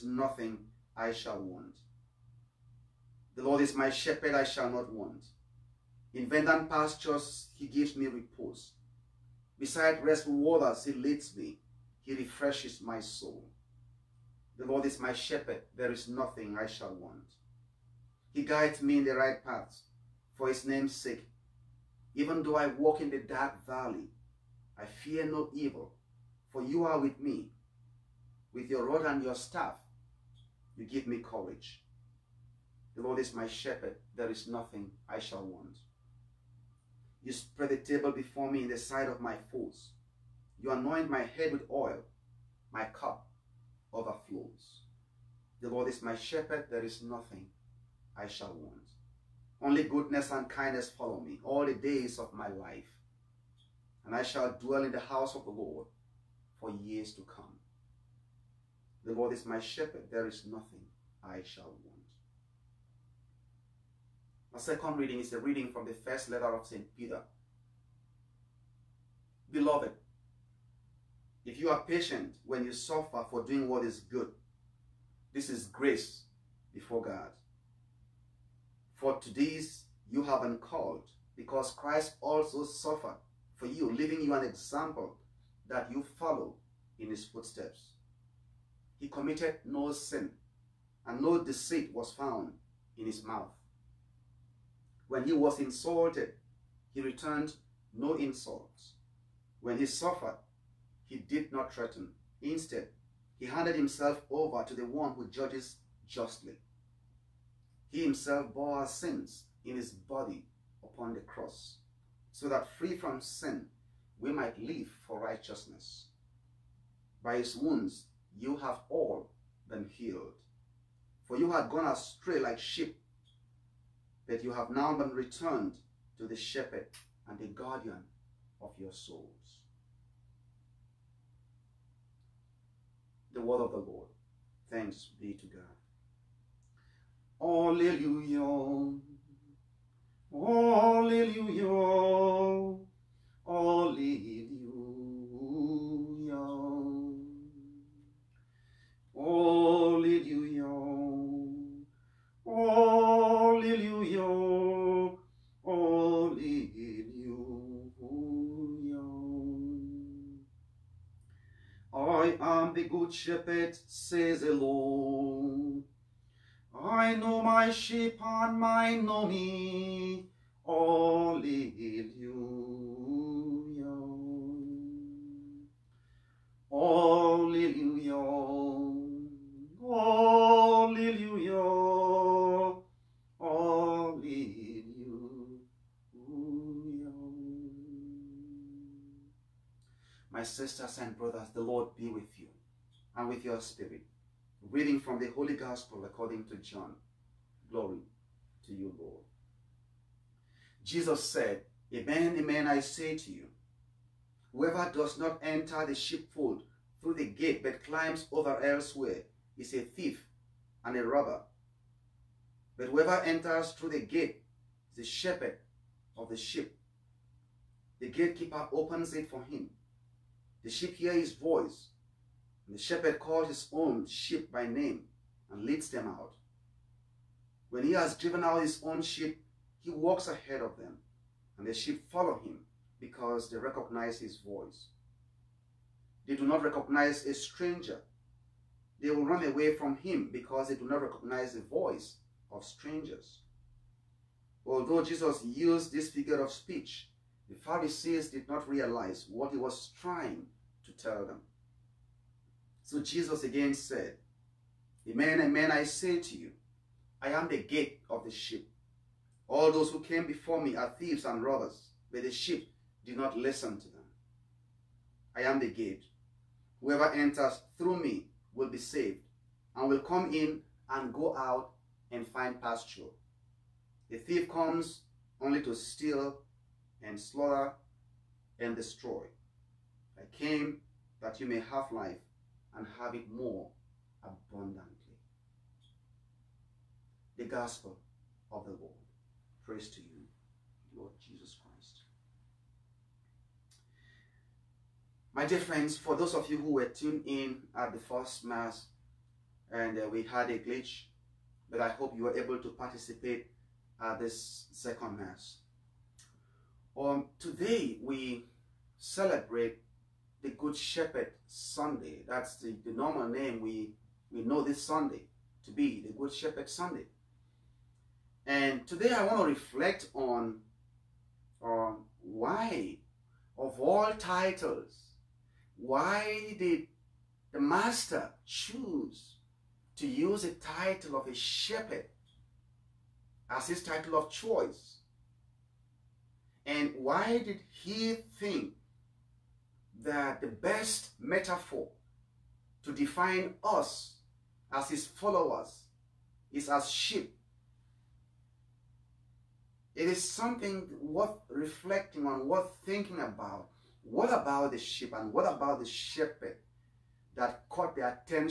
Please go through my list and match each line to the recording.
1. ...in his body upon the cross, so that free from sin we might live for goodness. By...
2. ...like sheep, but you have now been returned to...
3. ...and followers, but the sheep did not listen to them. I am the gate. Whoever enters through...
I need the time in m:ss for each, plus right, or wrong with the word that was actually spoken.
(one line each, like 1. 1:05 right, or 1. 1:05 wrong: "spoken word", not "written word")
1. 1:49 wrong: "righteousness", not "goodness"
2. 2:02 right
3. 4:21 wrong: "robbers", not "followers".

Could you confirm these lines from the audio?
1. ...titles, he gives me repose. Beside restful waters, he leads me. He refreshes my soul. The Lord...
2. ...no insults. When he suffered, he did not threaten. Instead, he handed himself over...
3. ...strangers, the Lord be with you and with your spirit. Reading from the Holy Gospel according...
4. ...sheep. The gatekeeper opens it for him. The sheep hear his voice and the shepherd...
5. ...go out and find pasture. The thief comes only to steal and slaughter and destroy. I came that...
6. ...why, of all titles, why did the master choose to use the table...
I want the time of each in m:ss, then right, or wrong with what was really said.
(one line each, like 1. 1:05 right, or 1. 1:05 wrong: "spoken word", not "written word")
1. 0:06 wrong: "pastures", not "titles"
2. 1:37 right
3. 3:11 wrong: "brothers", not "strangers"
4. 3:36 right
5. 4:31 right
6. 5:22 wrong: "title", not "table".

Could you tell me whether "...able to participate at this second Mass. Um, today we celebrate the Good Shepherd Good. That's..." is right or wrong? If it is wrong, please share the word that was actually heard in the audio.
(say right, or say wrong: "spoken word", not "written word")
wrong: "Sunday", not "Good".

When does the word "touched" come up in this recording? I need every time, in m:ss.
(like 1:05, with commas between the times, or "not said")
not said.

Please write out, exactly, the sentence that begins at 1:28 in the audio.
He committed no sin, and no deceit was found in his mouth.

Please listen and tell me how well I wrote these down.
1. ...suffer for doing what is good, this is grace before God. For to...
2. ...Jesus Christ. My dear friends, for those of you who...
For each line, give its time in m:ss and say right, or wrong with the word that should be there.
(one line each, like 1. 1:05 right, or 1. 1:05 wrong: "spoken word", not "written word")
1. 1:12 right
2. 4:51 right.